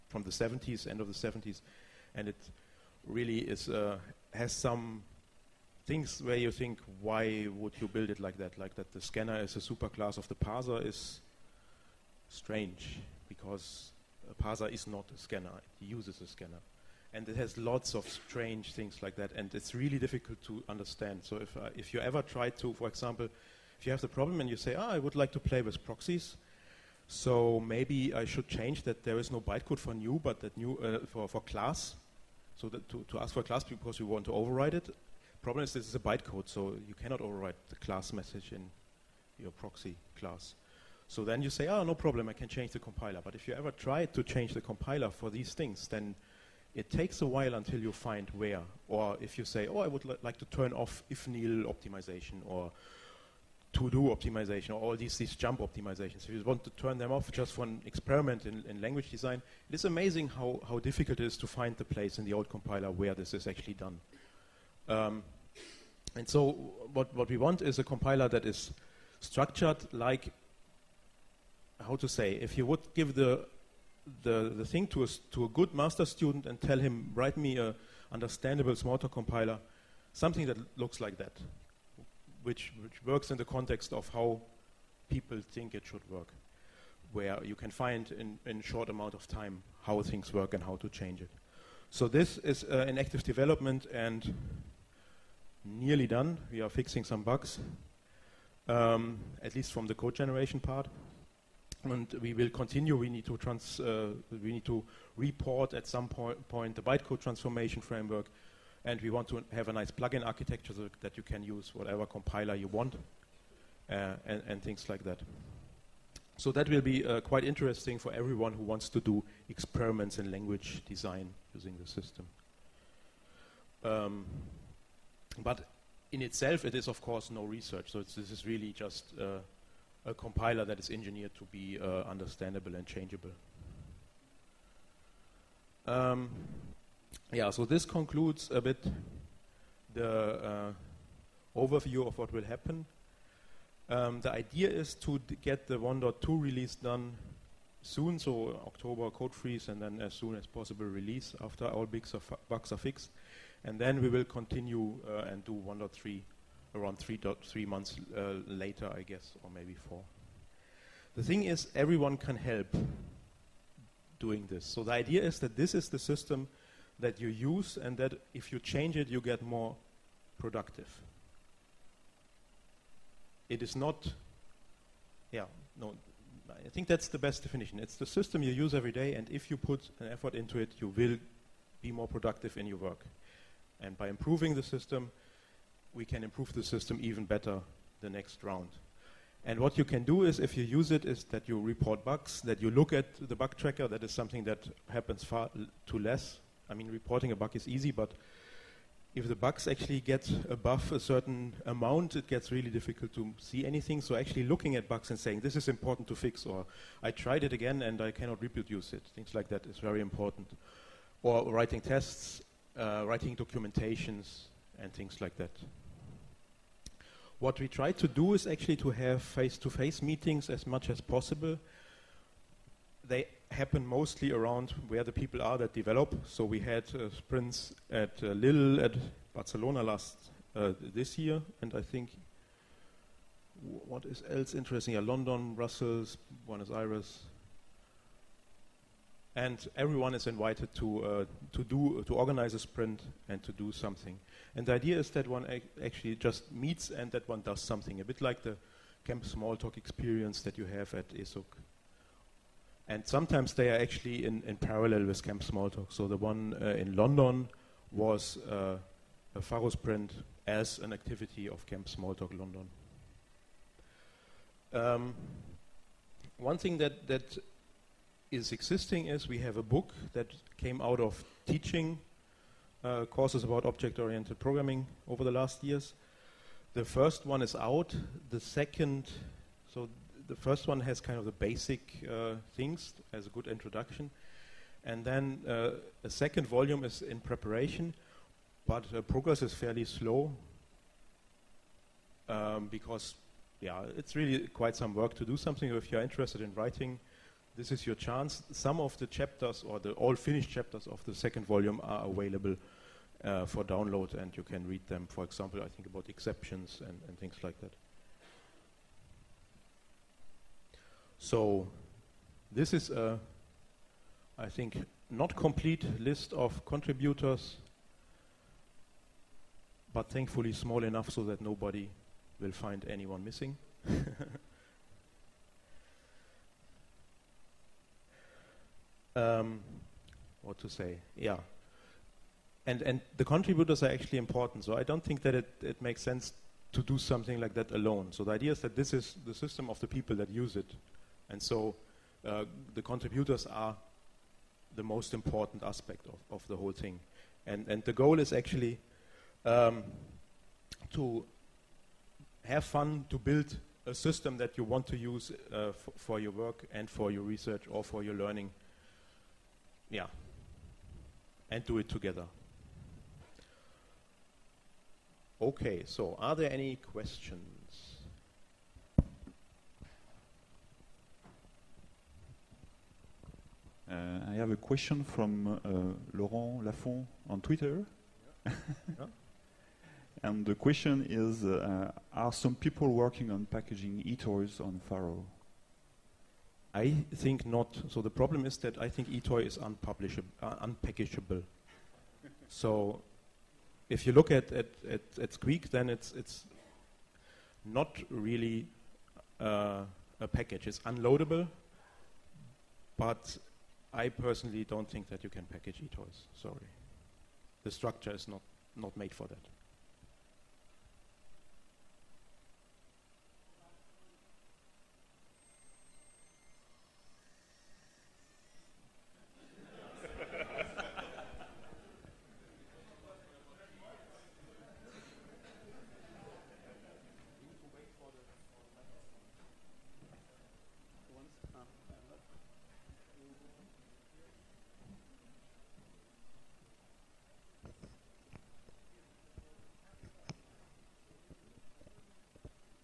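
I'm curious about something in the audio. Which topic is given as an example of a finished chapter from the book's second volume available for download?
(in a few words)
Exceptions.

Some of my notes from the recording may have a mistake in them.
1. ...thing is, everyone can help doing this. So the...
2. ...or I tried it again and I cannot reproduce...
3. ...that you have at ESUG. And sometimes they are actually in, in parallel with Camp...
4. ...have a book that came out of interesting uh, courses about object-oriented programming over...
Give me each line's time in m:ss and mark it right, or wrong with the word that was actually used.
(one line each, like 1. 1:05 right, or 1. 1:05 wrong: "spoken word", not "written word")
1. 2:41 right
2. 3:26 right
3. 4:10 right
4. 4:29 wrong: "teaching", not "interesting".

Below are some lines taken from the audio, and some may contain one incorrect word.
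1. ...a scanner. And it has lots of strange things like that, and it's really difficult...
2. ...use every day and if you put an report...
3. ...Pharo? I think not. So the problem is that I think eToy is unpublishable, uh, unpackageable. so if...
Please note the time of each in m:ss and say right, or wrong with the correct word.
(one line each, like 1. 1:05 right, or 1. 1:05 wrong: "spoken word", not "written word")
1. 0:16 right
2. 2:58 wrong: "effort", not "report"
3. 6:24 right.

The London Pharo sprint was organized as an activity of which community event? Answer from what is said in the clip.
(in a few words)
Camp Smalltalk London.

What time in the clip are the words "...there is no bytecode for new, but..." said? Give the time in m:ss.
0:29.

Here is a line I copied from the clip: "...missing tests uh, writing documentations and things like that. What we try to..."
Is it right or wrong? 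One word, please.
wrong.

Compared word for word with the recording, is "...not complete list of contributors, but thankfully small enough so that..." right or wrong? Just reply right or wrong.
right.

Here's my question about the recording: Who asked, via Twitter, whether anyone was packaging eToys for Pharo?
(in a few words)
Laurent Laffont.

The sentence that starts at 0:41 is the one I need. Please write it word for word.
So then you say, oh, no problem, I can change the compiler.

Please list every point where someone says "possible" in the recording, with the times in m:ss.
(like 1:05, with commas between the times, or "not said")
2:30, 3:41.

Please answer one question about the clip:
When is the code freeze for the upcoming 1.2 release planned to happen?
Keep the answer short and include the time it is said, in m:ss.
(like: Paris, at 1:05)
October, at 2:28.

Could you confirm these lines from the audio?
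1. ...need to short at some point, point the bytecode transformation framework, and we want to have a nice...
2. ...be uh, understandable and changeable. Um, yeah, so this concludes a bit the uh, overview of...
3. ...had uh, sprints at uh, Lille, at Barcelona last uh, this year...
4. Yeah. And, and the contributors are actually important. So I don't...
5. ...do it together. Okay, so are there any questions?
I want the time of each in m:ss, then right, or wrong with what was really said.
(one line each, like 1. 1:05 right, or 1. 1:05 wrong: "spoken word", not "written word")
1. 1:44 wrong: "report", not "short"
2. 2:11 right
3. 3:46 right
4. 5:31 right
5. 6:01 right.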